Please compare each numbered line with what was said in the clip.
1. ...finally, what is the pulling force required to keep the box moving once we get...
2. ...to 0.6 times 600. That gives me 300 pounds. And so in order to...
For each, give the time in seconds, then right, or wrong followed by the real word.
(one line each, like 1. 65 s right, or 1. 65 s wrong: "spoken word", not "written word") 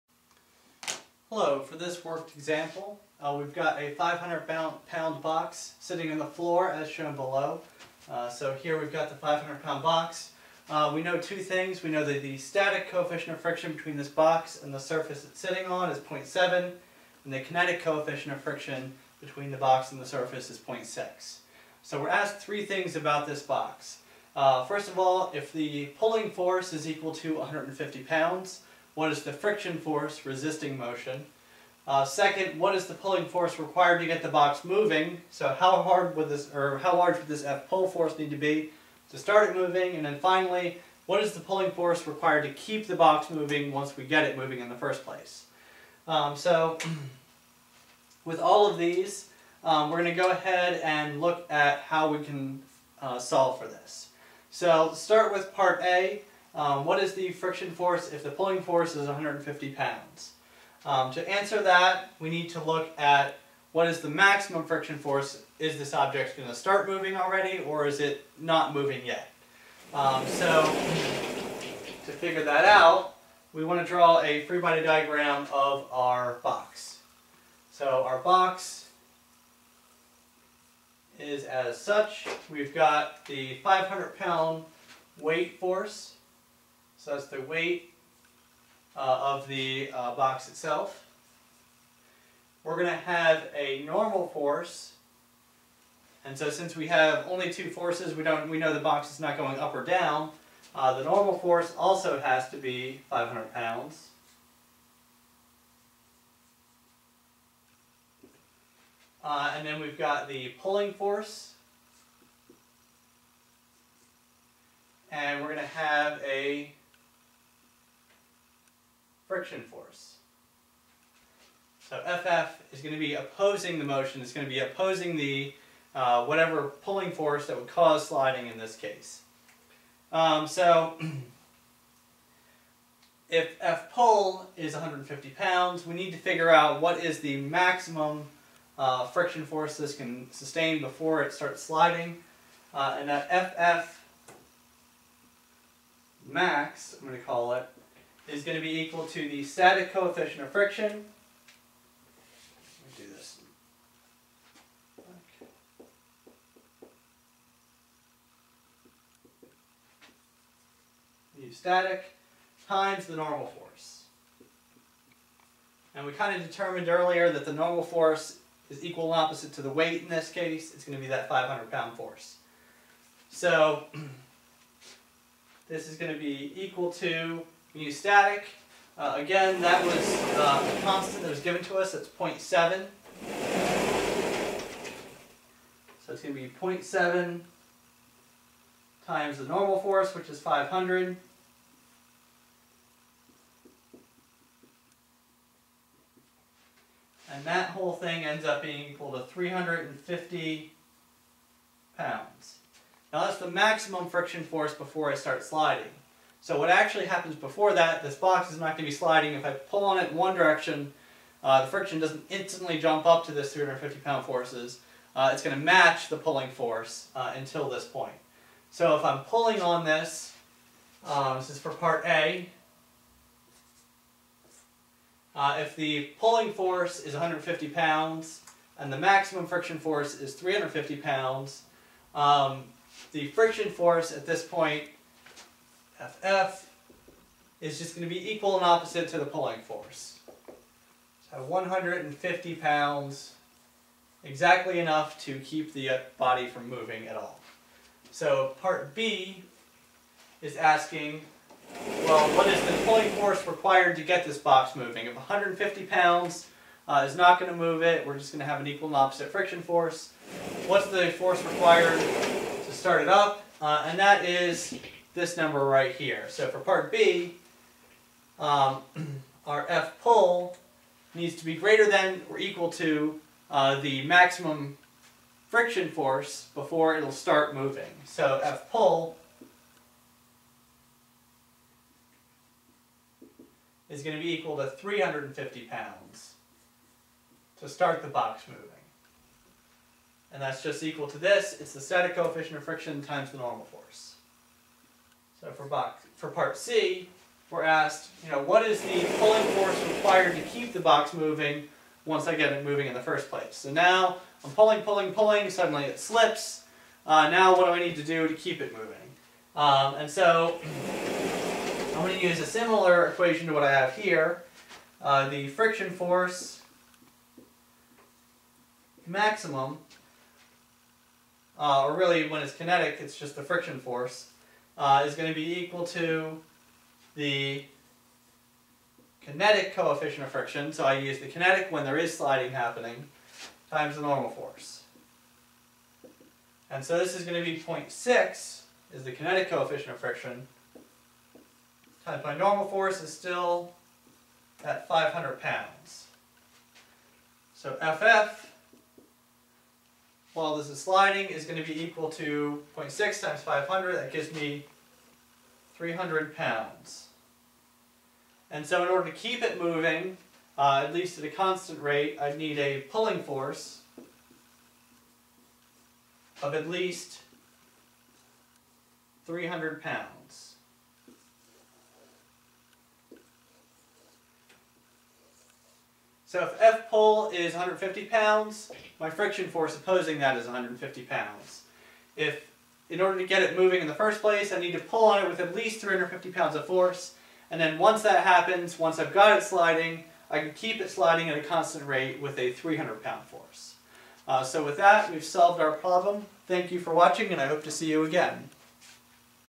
1. 40 s right
2. 352 s wrong: "500", not "600".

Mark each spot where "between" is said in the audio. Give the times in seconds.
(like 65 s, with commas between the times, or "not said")
13 s, 19 s.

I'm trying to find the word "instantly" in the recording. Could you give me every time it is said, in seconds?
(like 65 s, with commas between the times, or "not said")
212 s.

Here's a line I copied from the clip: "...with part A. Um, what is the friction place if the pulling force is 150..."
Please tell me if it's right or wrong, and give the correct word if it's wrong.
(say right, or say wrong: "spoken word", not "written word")
wrong: "force", not "place".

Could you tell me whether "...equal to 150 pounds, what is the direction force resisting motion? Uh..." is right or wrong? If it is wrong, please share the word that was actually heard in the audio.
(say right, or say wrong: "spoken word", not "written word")
wrong: "friction", not "direction".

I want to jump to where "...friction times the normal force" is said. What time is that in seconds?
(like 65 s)
292 s.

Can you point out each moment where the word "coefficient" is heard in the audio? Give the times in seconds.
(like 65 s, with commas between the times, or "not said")
12 s, 17 s, 149 s, 292 s, 329 s, 339 s.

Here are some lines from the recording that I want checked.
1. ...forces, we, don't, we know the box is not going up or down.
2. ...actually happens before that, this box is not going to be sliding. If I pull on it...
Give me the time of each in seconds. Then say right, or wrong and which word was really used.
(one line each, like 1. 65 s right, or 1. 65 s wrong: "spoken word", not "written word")
1. 97 s right
2. 206 s right.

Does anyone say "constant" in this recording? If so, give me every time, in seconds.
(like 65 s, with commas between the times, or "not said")
180 s, 361 s, 391 s.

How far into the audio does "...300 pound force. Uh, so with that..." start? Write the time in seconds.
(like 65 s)
392 s.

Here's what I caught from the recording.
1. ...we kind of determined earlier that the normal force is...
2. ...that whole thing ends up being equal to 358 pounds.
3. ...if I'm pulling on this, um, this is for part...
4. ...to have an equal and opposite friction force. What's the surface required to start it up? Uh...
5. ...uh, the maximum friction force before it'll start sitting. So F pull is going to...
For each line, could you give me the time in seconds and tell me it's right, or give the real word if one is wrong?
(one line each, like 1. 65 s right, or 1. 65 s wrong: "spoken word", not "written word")
1. 166 s right
2. 197 s wrong: "350", not "358"
3. 218 s right
4. 258 s wrong: "force", not "surface"
5. 273 s wrong: "moving", not "sitting".